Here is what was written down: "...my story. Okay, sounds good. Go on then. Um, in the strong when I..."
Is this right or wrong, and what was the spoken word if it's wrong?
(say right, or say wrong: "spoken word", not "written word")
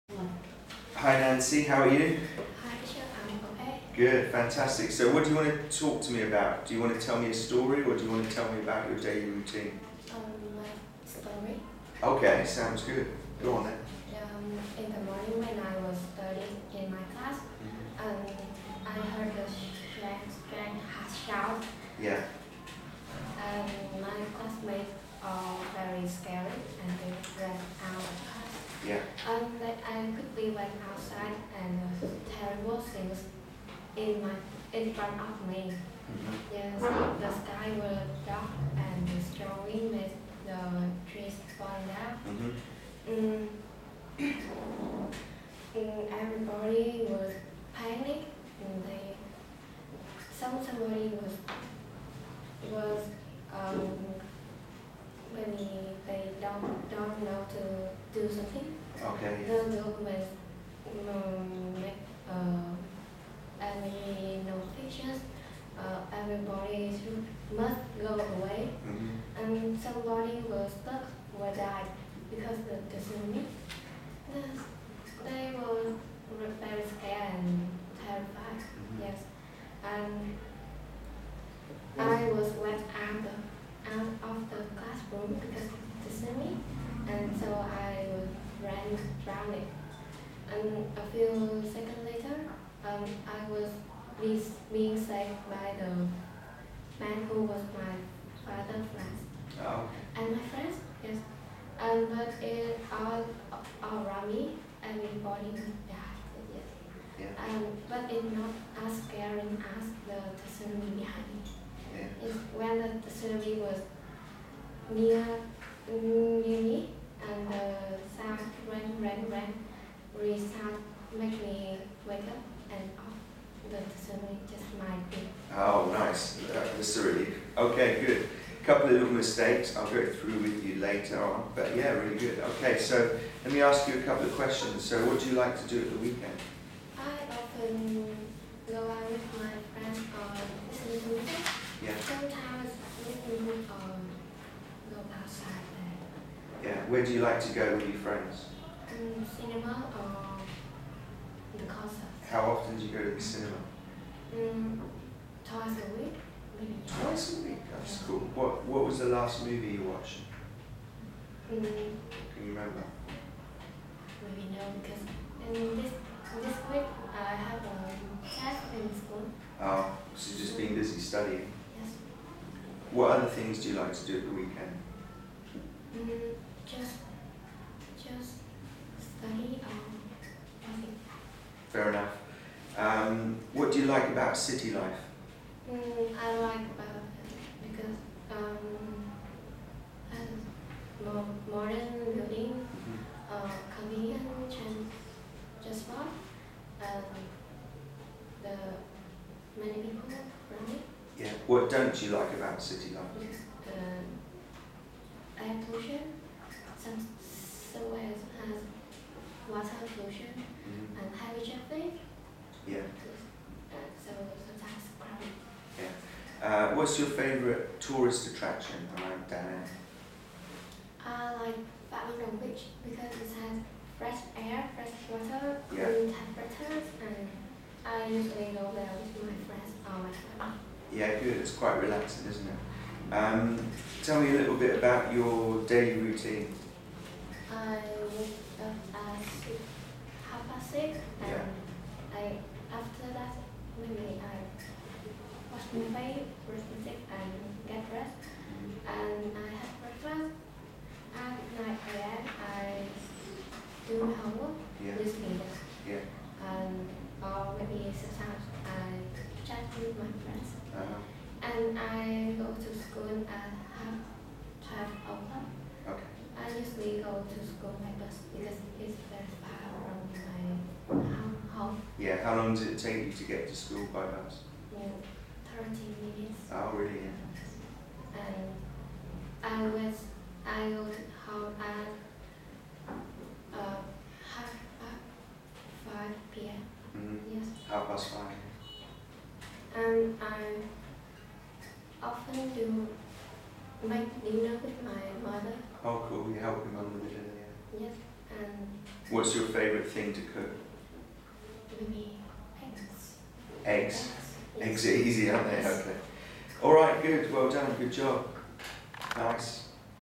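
wrong: "morning", not "strong".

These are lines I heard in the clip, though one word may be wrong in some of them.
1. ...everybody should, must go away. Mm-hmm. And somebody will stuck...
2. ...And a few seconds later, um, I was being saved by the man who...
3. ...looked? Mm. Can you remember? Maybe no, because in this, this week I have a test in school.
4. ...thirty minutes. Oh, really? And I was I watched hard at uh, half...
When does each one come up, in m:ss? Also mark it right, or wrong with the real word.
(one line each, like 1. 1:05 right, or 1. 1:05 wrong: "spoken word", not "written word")
1. 1:06 right
2. 1:30 right
3. 2:39 wrong: "watched", not "looked"
4. 4:35 wrong: "looked", not "watched".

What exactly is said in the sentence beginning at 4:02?
I after that maybe I wash my face, brush my teeth, and get dressed, mm-hmm.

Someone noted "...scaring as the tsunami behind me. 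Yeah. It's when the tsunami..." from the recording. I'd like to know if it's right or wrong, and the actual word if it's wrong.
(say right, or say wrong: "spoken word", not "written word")
right.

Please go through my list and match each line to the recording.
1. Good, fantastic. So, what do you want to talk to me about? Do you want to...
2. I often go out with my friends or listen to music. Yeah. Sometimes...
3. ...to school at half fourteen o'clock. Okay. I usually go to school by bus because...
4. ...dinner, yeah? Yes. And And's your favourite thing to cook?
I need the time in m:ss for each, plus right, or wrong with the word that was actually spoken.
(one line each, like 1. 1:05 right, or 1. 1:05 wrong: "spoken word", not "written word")
1. 0:03 right
2. 2:16 right
3. 4:22 wrong: "twelve", not "fourteen"
4. 4:57 wrong: "What", not "And".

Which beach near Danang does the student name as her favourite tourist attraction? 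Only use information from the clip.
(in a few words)
Babylon Beach.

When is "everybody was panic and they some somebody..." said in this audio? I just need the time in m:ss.
0:46.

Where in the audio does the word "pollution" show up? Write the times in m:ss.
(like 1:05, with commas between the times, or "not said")
3:25, 3:29.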